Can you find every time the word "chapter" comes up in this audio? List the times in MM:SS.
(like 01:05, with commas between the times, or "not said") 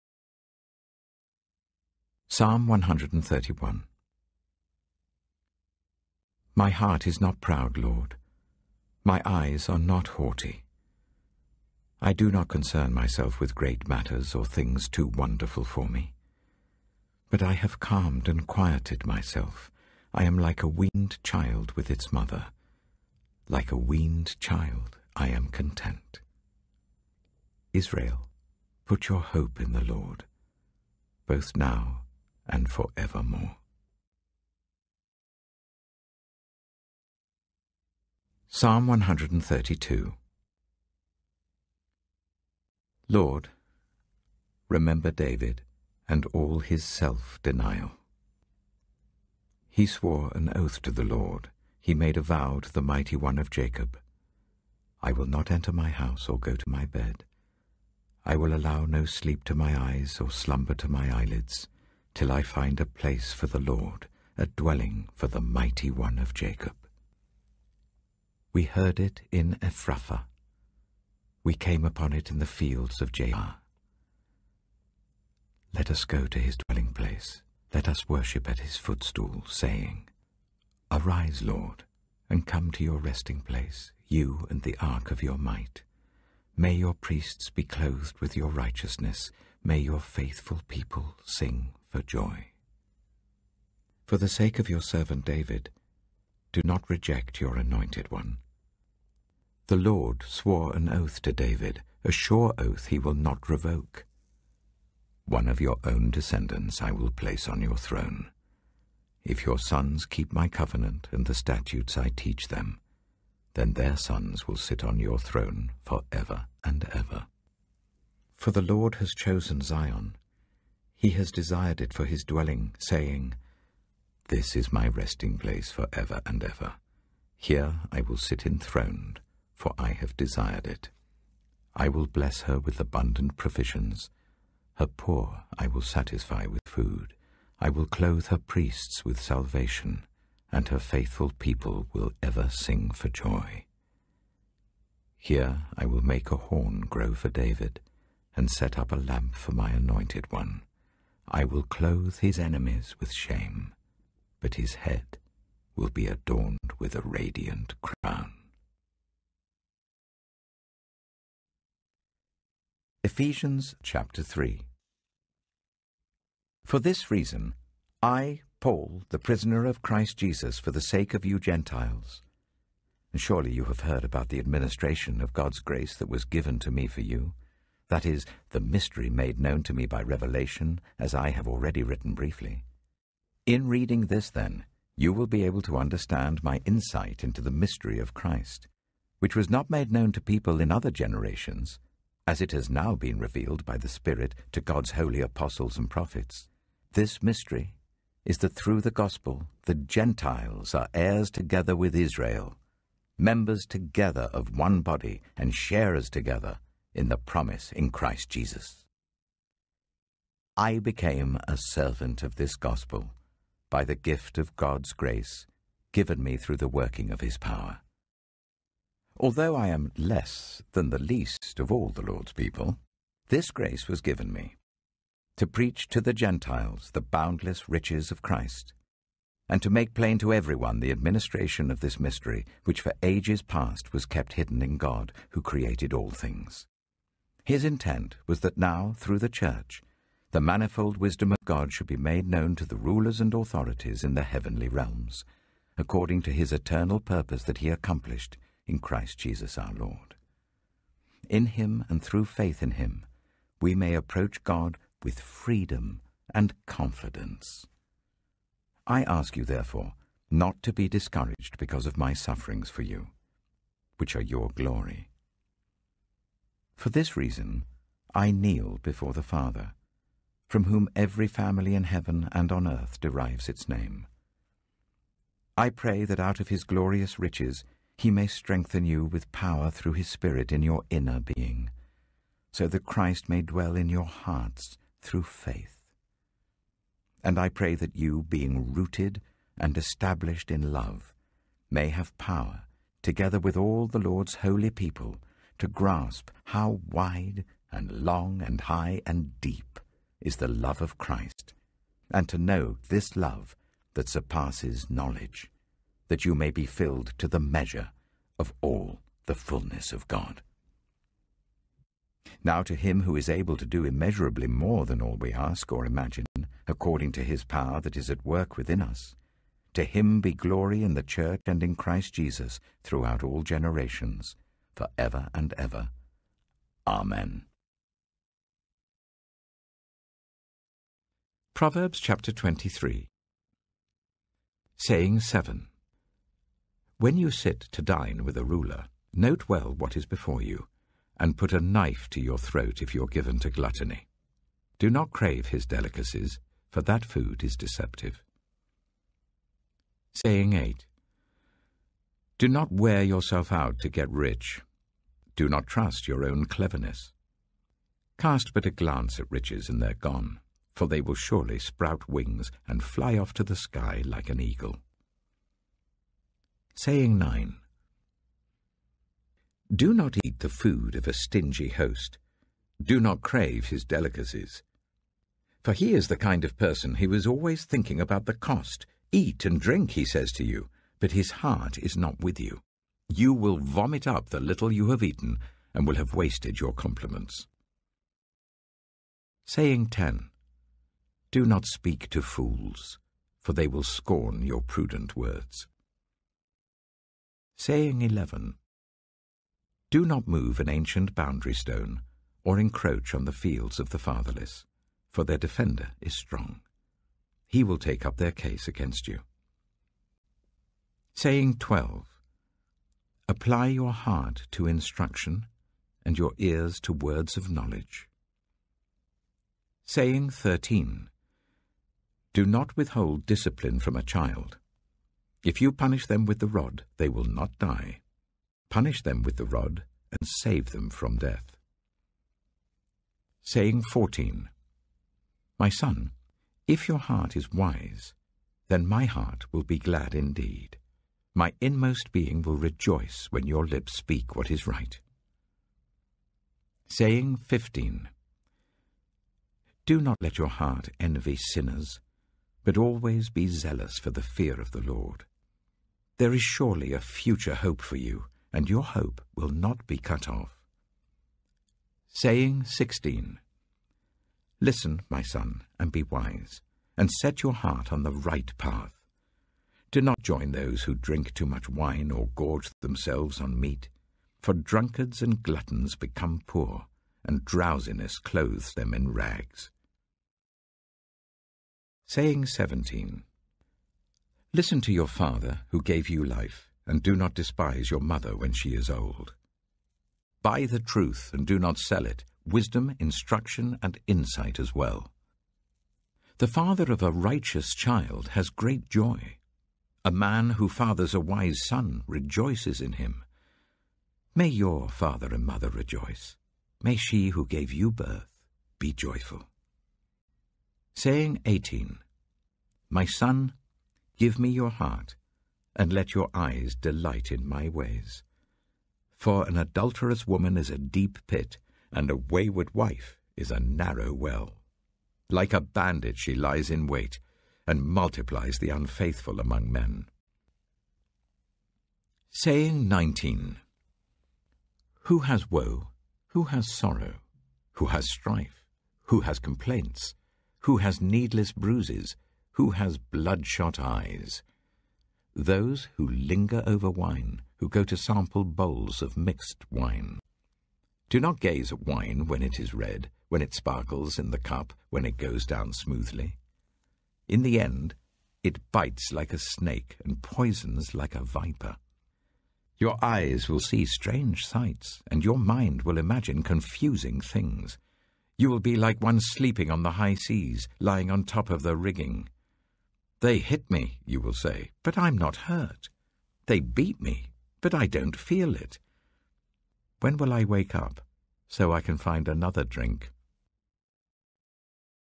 02:43, 05:31.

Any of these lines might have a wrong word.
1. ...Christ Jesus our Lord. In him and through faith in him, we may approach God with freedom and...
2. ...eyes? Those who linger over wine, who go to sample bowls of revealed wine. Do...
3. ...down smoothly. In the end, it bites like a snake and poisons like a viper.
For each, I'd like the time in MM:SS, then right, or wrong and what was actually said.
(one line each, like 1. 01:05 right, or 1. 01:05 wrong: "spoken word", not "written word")
1. 04:08 right
2. 09:03 wrong: "mixed", not "revealed"
3. 09:15 right.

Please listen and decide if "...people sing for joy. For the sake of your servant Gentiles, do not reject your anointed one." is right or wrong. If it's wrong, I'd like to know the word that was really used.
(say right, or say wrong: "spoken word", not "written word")
wrong: "David", not "Gentiles".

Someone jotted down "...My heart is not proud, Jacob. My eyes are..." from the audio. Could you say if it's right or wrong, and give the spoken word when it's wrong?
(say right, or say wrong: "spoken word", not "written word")
wrong: "Lord", not "Jacob".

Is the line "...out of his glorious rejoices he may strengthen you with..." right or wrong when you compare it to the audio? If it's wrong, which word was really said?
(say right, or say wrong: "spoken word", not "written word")
wrong: "riches", not "rejoices".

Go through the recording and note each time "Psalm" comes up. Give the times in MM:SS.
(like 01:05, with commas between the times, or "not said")
00:02, 00:38.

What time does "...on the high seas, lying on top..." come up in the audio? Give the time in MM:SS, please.
09:29.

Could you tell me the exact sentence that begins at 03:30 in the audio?
I became a servant of this gospel by the gift of God's grace given me through the working of his power.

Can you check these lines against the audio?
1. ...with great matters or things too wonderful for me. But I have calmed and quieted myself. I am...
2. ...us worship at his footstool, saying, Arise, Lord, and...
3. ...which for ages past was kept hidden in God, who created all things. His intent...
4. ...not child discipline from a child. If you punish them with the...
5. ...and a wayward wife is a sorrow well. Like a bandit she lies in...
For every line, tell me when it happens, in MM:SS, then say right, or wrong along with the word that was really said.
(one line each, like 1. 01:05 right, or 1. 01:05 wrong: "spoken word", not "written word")
1. 00:13 right
2. 01:17 right
3. 03:52 right
4. 07:02 wrong: "withhold", not "child"
5. 08:41 wrong: "narrow", not "sorrow".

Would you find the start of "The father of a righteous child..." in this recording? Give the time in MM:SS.
08:16.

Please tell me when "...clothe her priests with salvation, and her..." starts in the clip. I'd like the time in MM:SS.
02:17.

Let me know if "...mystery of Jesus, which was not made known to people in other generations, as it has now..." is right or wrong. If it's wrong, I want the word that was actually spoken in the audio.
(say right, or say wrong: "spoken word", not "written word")
wrong: "Christ", not "Jesus".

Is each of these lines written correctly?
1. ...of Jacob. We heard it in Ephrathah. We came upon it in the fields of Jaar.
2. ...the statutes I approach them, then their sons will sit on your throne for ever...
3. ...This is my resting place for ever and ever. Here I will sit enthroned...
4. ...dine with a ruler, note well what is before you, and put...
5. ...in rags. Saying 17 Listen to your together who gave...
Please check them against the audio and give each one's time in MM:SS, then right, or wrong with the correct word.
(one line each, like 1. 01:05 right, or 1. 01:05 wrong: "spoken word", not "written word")
1. 01:06 right
2. 01:51 wrong: "teach", not "approach"
3. 02:04 right
4. 05:37 right
5. 07:58 wrong: "father", not "together".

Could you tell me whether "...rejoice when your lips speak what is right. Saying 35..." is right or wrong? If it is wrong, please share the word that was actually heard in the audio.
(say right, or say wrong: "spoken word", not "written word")
wrong: "15", not "35".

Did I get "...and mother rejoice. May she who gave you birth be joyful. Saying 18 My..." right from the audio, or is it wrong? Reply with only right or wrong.
right.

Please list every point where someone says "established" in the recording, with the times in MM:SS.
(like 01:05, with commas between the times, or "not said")
04:49.